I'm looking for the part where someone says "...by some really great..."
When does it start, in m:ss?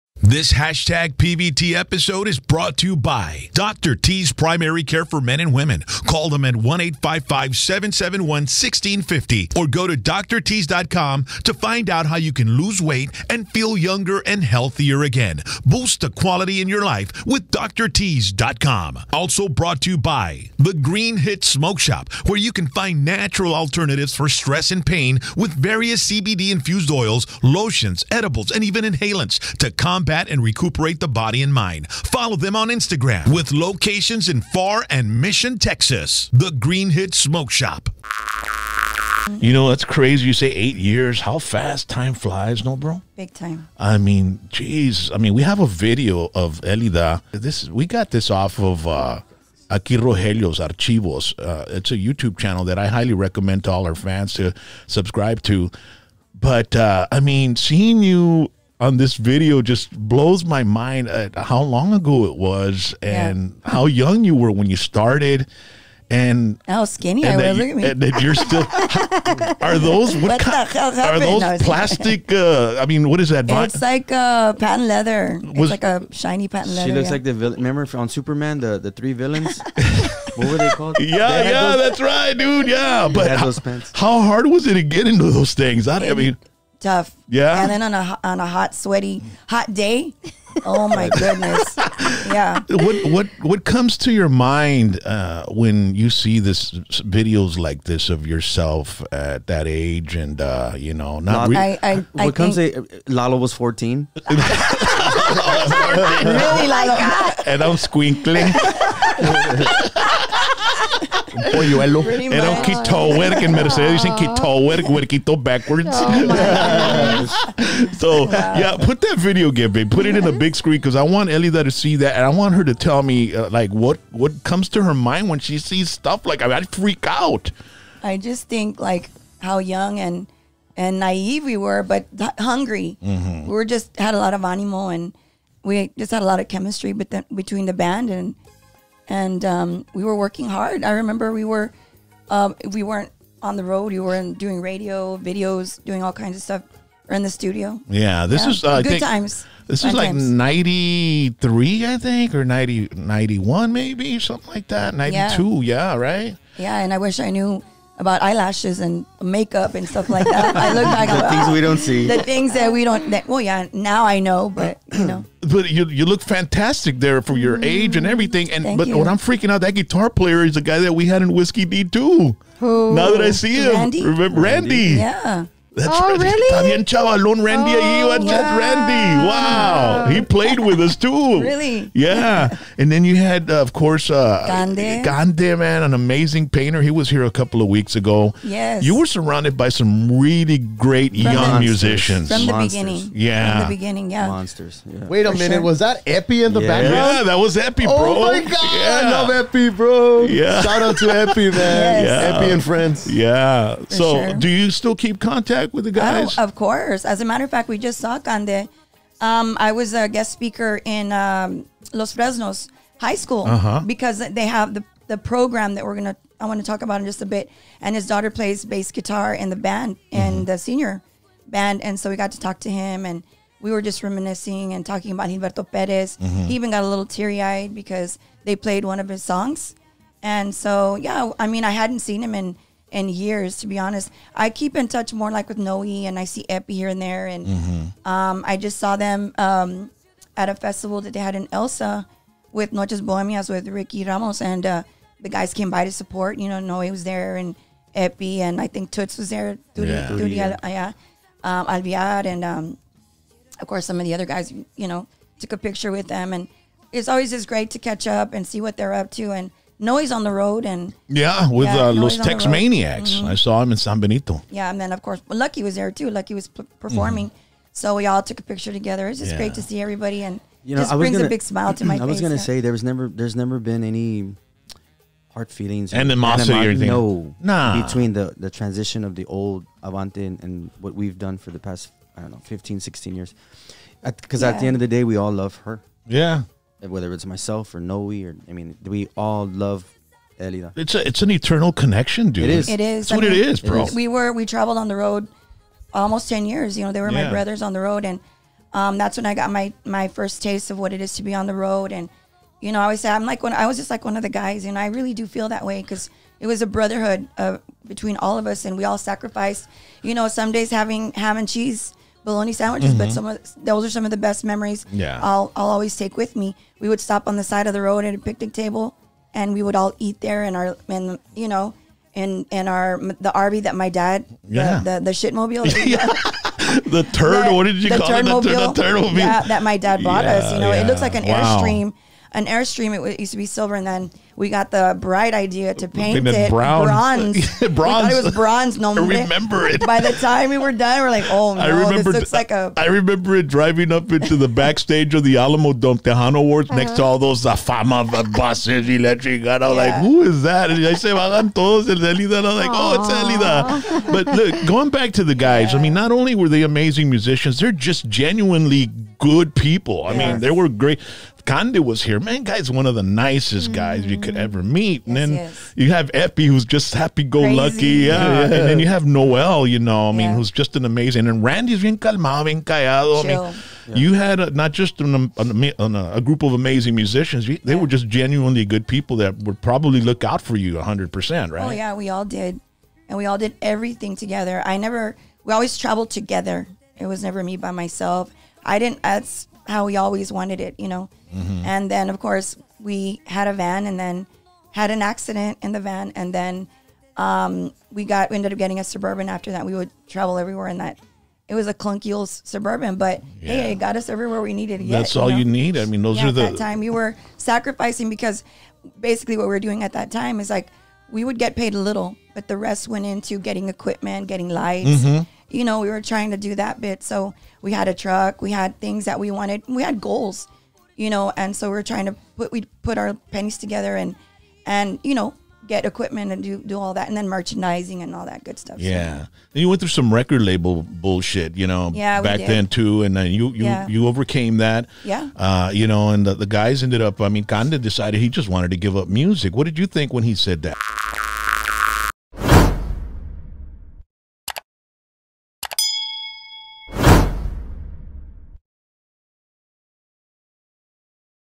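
3:09.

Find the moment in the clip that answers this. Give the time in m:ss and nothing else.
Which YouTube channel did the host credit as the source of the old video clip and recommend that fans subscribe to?
0:49.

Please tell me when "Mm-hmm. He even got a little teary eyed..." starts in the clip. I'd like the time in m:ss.
3:46.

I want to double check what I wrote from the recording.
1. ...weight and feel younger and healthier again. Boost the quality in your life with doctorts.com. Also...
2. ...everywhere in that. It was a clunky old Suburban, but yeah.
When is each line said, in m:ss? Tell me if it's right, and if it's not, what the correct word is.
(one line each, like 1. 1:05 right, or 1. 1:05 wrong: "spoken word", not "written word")
1. 0:12 right
2. 6:40 right.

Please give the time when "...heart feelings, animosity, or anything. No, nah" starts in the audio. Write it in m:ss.
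4:35.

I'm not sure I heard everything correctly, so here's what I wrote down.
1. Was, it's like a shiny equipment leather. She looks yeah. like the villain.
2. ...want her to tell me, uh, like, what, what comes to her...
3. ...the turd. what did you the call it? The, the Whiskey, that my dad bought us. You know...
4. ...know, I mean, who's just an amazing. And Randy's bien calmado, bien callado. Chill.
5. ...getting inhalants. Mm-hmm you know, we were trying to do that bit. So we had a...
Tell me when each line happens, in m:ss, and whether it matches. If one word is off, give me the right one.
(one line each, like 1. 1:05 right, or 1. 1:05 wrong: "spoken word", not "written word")
1. 1:15 wrong: "patent", not "equipment"
2. 2:02 right
3. 5:26 wrong: "Yeah", not "Whiskey"
4. 6:09 right
5. 6:54 wrong: "lights", not "inhalants".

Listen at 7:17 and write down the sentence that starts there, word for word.
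I mean, Cande decided he just wanted to give up music.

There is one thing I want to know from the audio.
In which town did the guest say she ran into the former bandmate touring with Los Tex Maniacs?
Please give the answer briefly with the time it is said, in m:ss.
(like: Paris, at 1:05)
San Benito, at 4:23.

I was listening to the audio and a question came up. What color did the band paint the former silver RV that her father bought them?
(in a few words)
Brown.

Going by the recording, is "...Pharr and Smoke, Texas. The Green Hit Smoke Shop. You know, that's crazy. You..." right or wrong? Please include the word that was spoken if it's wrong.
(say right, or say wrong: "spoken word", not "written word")
wrong: "Mission", not "Smoke".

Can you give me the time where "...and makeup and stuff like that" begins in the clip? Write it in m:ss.
2:38.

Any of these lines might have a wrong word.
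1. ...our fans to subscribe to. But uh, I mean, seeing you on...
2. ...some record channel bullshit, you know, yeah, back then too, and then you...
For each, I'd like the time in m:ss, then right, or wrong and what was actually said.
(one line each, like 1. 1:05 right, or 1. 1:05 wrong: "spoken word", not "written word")
1. 0:53 right
2. 7:09 wrong: "label", not "channel".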